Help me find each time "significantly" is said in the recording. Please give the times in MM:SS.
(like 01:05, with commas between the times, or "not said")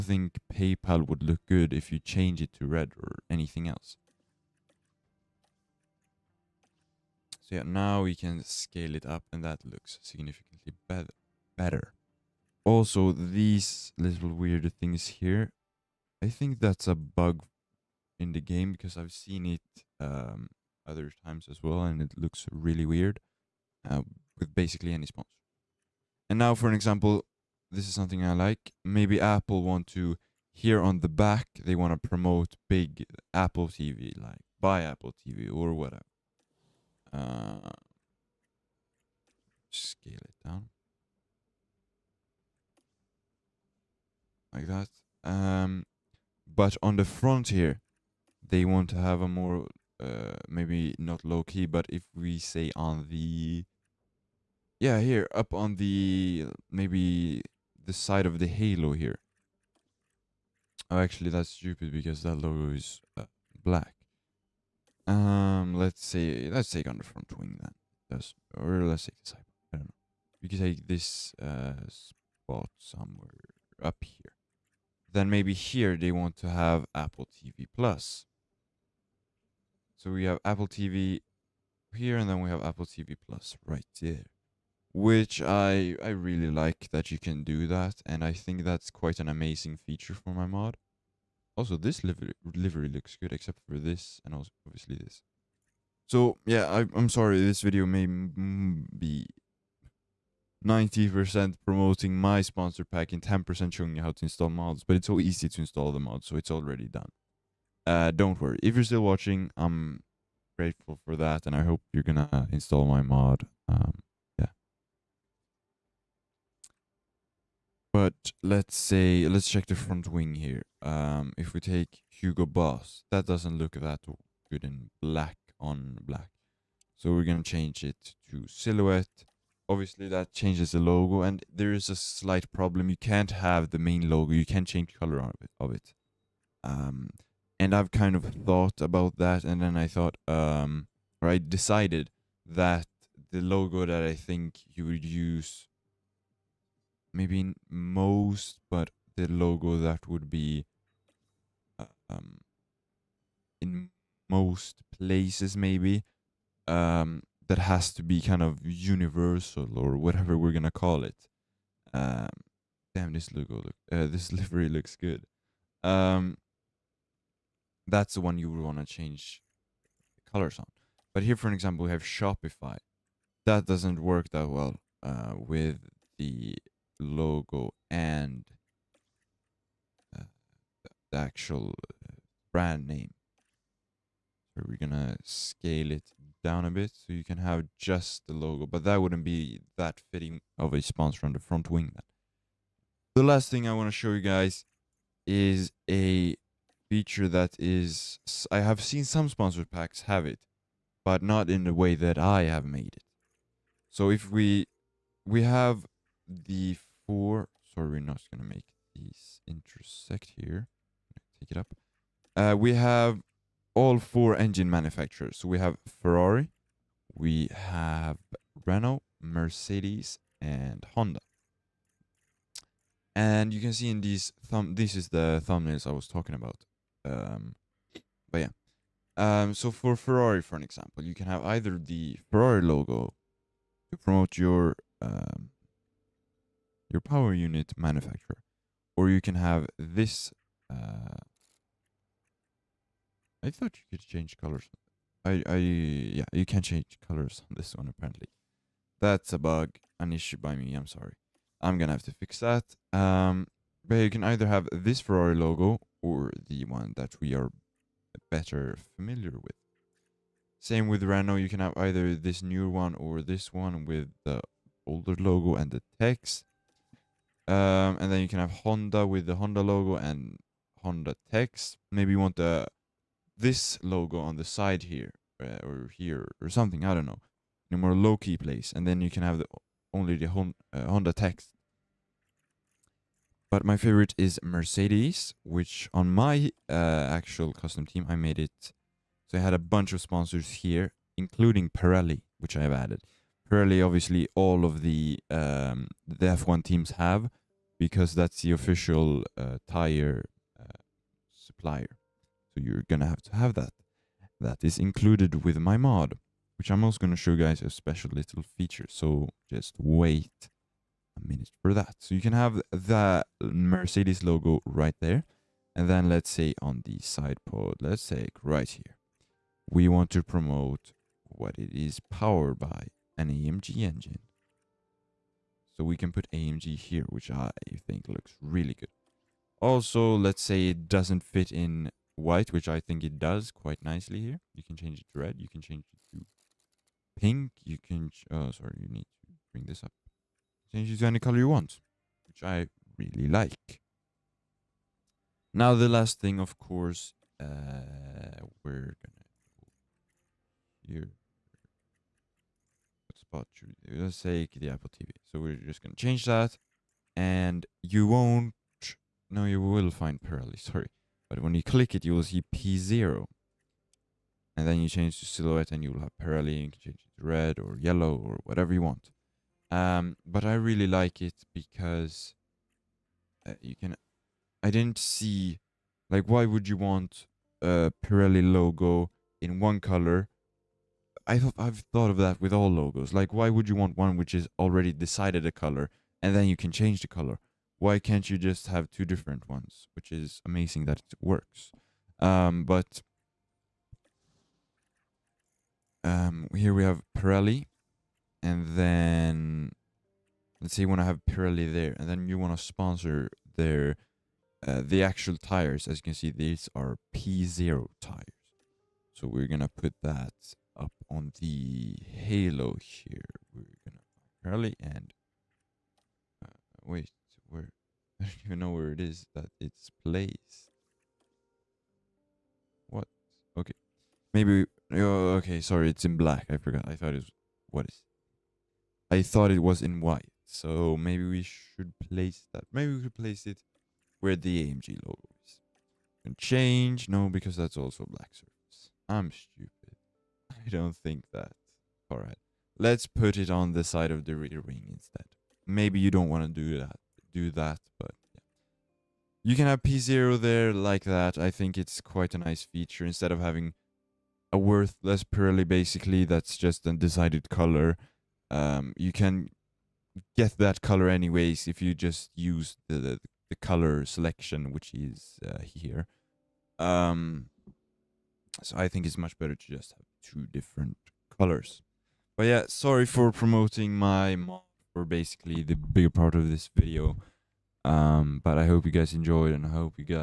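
00:10.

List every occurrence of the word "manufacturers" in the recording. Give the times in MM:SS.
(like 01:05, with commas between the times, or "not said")
03:34, 03:57.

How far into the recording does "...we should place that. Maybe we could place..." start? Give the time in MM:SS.
07:11.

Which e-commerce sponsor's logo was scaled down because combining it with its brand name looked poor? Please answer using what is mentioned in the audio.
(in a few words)
Shopify.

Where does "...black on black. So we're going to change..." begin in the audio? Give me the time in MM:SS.
02:05.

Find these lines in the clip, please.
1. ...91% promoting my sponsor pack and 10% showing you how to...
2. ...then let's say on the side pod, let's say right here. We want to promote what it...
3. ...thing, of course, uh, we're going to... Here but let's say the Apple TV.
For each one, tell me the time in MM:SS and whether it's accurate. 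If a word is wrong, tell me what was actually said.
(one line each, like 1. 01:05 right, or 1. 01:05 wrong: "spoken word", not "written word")
1. 01:40 wrong: "90", not "91"
2. 05:15 right
3. 05:46 right.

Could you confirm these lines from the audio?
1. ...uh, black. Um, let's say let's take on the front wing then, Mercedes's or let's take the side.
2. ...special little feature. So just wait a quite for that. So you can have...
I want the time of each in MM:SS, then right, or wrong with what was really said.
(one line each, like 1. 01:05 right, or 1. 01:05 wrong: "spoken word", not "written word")
1. 01:03 wrong: "That", not "Mercedes"
2. 05:07 wrong: "minute", not "quite".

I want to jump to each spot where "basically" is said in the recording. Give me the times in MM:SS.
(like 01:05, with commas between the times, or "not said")
00:24, 07:35, 07:55.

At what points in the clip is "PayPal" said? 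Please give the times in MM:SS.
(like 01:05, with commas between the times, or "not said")
00:00.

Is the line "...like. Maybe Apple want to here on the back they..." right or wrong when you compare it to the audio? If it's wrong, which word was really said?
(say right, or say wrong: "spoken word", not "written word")
right.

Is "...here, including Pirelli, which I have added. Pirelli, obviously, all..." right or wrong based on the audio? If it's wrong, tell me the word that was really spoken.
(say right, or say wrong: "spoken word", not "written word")
right.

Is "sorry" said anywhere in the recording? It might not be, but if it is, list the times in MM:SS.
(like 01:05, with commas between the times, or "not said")
01:37, 03:27, 04:10, 05:38, 06:00, 07:05, 07:52.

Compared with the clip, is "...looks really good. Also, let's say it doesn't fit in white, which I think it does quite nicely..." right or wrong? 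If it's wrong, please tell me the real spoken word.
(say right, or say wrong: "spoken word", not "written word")
right.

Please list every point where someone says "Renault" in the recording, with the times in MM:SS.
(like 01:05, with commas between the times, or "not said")
03:38, 04:21.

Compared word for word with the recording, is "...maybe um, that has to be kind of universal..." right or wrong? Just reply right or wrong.
right.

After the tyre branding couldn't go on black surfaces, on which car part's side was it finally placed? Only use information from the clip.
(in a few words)
Rear wing.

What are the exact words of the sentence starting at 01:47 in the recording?
Uh, don't worry, if you're still watching, I'm grateful for that, and I hope you're gonna install my mod.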